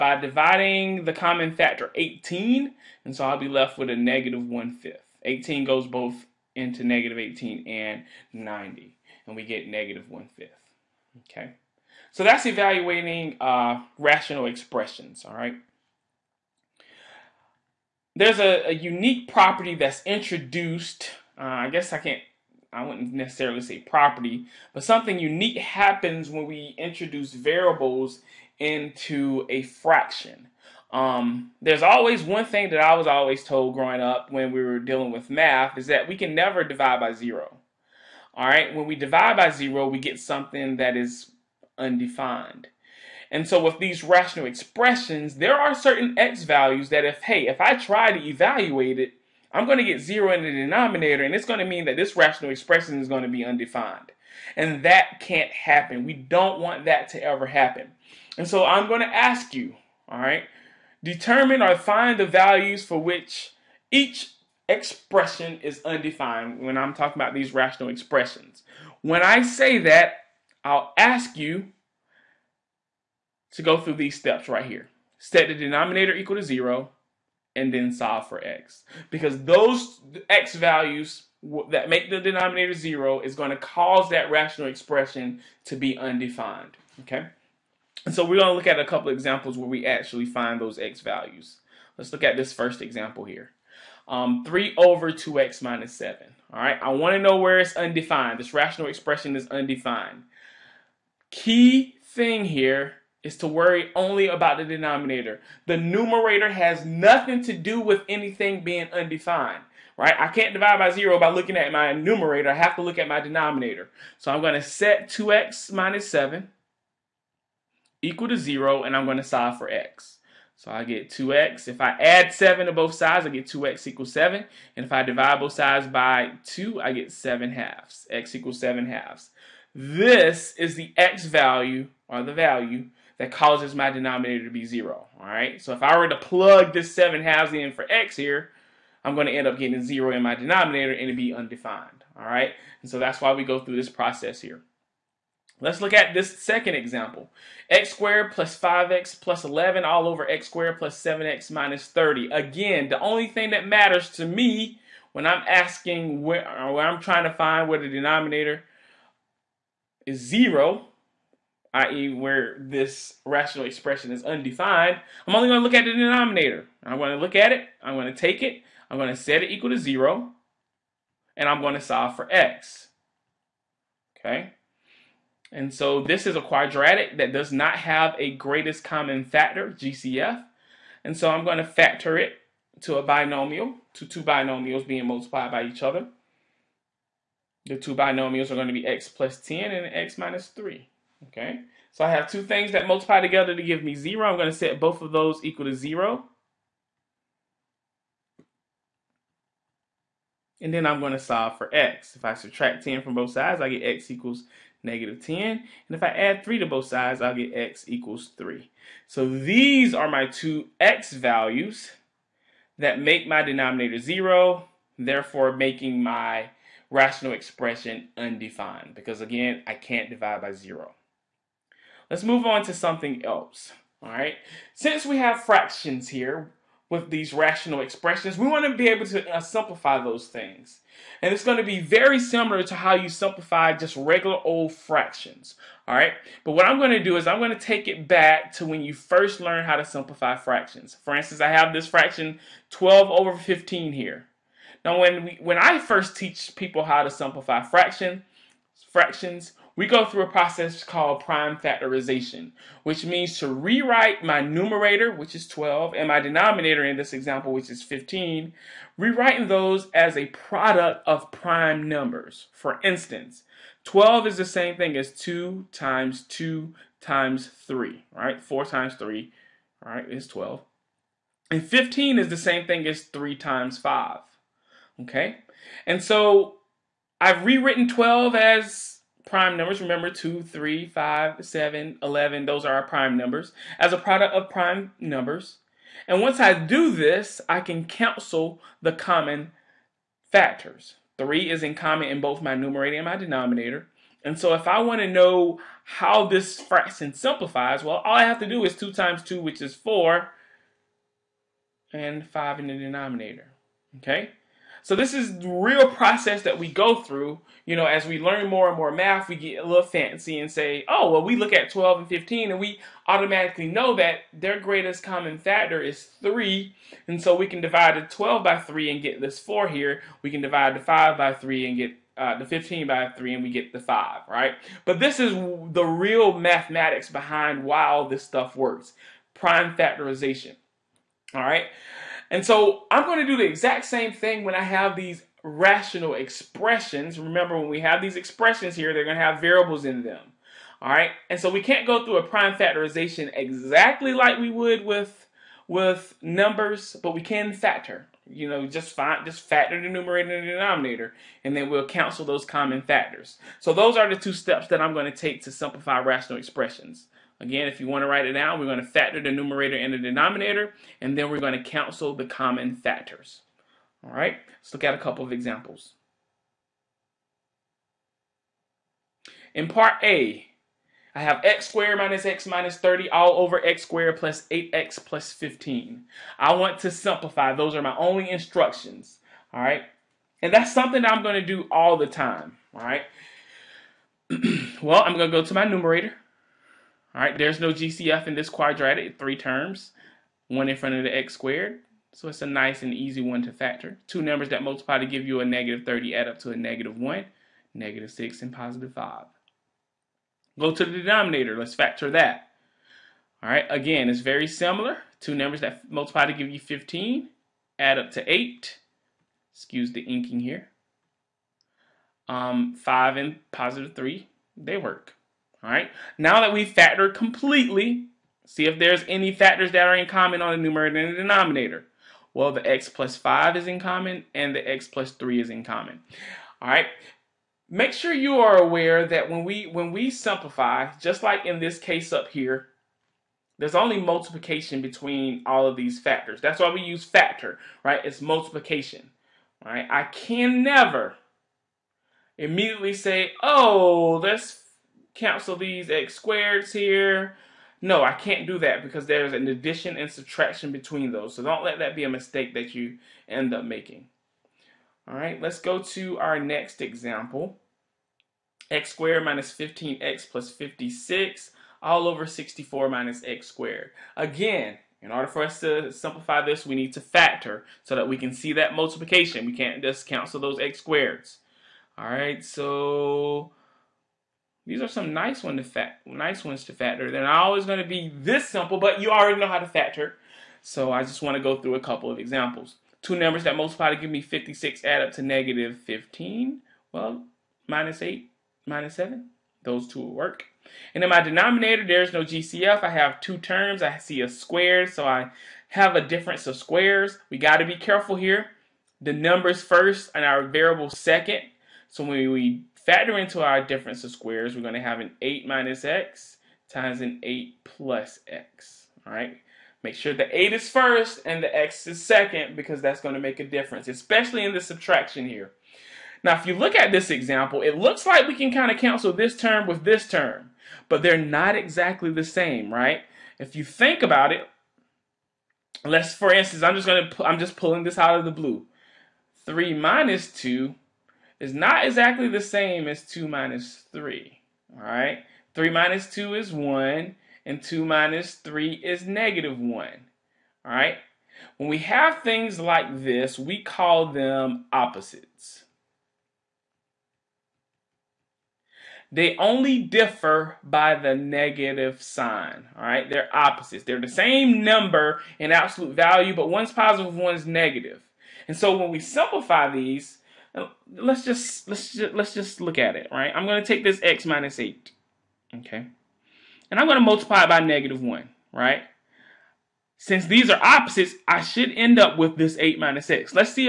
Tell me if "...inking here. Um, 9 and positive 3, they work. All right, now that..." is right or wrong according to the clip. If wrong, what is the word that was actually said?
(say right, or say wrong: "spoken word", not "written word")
wrong: "5", not "9".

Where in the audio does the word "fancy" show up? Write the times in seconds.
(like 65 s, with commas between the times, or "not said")
309 s.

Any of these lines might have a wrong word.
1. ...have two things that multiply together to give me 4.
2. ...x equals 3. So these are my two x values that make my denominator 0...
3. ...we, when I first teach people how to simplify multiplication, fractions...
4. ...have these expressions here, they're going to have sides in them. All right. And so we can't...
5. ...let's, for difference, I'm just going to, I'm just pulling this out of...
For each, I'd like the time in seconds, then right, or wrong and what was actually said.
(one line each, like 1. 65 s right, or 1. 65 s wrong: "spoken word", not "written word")
1. 192 s wrong: "0", not "4"
2. 207 s right
3. 245 s wrong: "fraction", not "multiplication"
4. 337 s wrong: "variables", not "sides"
5. 525 s wrong: "instance", not "difference".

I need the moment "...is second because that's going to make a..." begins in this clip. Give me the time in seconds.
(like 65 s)
511 s.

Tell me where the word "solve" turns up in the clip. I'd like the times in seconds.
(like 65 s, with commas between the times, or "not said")
77 s, 119 s, 171 s, 201 s.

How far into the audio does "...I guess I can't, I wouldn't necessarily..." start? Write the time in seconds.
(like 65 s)
21 s.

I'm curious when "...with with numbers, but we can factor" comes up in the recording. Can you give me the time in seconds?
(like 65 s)
344 s.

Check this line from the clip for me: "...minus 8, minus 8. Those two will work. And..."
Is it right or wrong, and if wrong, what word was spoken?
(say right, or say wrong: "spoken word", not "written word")
wrong: "7", not "8".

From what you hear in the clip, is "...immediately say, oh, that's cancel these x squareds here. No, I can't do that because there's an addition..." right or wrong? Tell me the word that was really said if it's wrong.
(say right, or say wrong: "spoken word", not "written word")
right.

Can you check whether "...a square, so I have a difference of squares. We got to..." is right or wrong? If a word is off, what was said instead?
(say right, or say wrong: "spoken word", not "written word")
right.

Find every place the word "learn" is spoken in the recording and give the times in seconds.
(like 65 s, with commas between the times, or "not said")
239 s, 308 s.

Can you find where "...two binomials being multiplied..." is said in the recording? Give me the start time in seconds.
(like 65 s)
184 s.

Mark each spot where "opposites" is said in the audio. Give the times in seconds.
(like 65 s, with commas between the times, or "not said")
544 s, 553 s, 570 s.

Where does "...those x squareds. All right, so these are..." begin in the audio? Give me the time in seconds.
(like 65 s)
470 s.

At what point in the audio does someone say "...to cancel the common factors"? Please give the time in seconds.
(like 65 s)
361 s.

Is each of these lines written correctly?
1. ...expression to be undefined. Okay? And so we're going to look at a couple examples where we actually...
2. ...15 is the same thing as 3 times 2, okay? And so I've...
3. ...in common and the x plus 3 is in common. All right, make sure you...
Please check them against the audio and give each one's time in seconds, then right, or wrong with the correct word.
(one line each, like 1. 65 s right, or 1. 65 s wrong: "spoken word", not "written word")
1. 84 s right
2. 271 s wrong: "5", not "2"
3. 423 s right.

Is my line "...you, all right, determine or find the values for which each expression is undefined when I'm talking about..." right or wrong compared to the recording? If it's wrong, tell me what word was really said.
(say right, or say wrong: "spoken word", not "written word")
right.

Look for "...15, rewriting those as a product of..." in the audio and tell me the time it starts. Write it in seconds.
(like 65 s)
257 s.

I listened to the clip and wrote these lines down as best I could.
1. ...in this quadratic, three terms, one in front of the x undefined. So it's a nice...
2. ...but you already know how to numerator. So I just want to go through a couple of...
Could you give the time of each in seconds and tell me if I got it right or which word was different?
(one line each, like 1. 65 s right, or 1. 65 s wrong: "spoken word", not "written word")
1. 388 s wrong: "squared", not "undefined"
2. 478 s wrong: "factor", not "numerator".